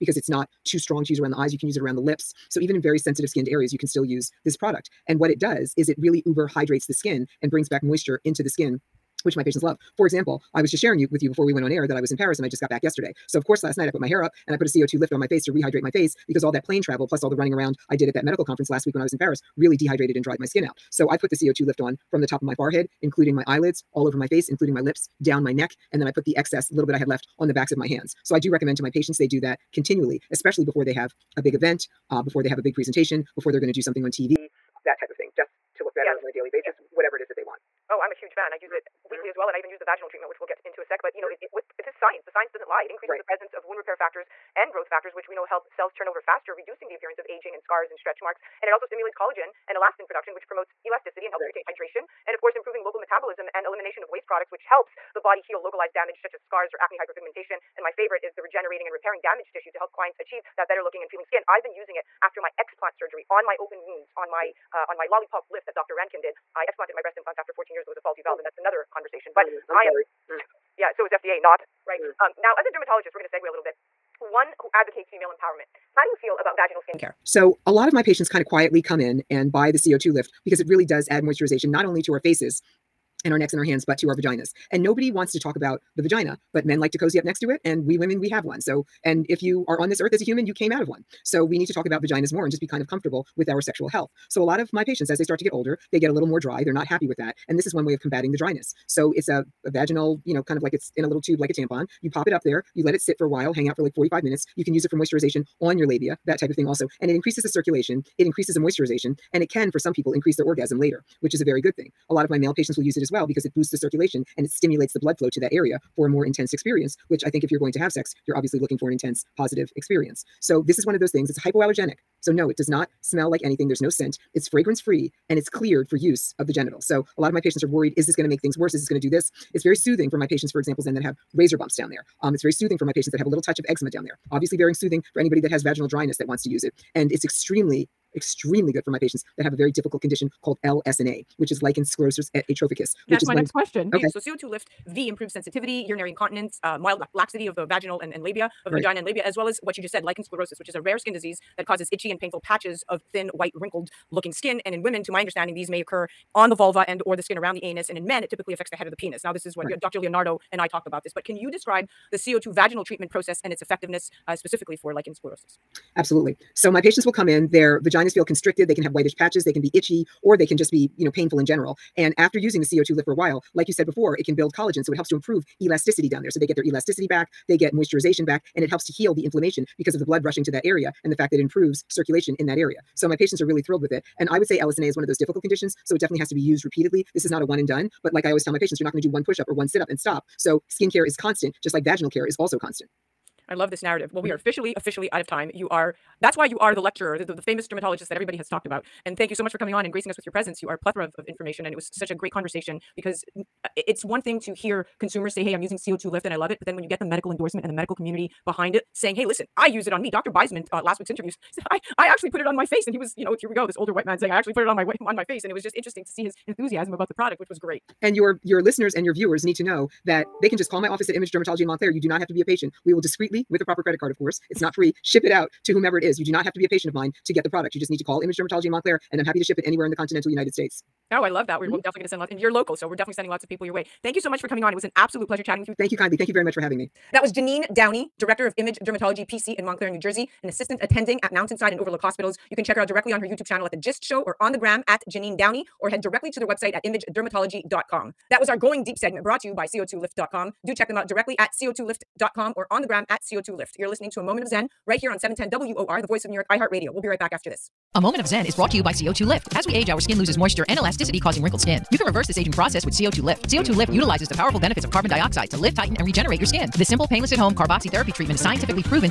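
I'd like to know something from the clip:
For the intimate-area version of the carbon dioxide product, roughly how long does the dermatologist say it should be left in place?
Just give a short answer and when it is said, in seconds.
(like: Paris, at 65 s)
45 minutes, at 103 s.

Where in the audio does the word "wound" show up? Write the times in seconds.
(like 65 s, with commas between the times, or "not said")
43 s, 63 s.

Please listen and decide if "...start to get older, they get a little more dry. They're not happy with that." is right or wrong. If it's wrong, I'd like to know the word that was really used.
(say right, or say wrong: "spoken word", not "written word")
right.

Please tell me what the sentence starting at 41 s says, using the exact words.
it, it, with this science the science doesn't lie it increases right.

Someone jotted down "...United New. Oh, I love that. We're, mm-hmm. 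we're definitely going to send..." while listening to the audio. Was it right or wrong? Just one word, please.
wrong.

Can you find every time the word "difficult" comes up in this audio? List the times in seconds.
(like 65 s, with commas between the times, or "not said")
139 s, 185 s.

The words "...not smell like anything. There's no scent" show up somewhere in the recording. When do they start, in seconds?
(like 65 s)
122 s.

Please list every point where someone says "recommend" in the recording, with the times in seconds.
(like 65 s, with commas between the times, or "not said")
28 s.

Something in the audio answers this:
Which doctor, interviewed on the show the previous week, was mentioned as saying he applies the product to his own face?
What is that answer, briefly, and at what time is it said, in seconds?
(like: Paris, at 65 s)
Dr. Beisman, at 210 s.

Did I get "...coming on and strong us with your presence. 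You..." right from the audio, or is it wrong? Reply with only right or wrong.
wrong.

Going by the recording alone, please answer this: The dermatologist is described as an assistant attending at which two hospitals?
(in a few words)
Mountainside and Overlook.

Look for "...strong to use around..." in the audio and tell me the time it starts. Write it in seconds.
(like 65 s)
0 s.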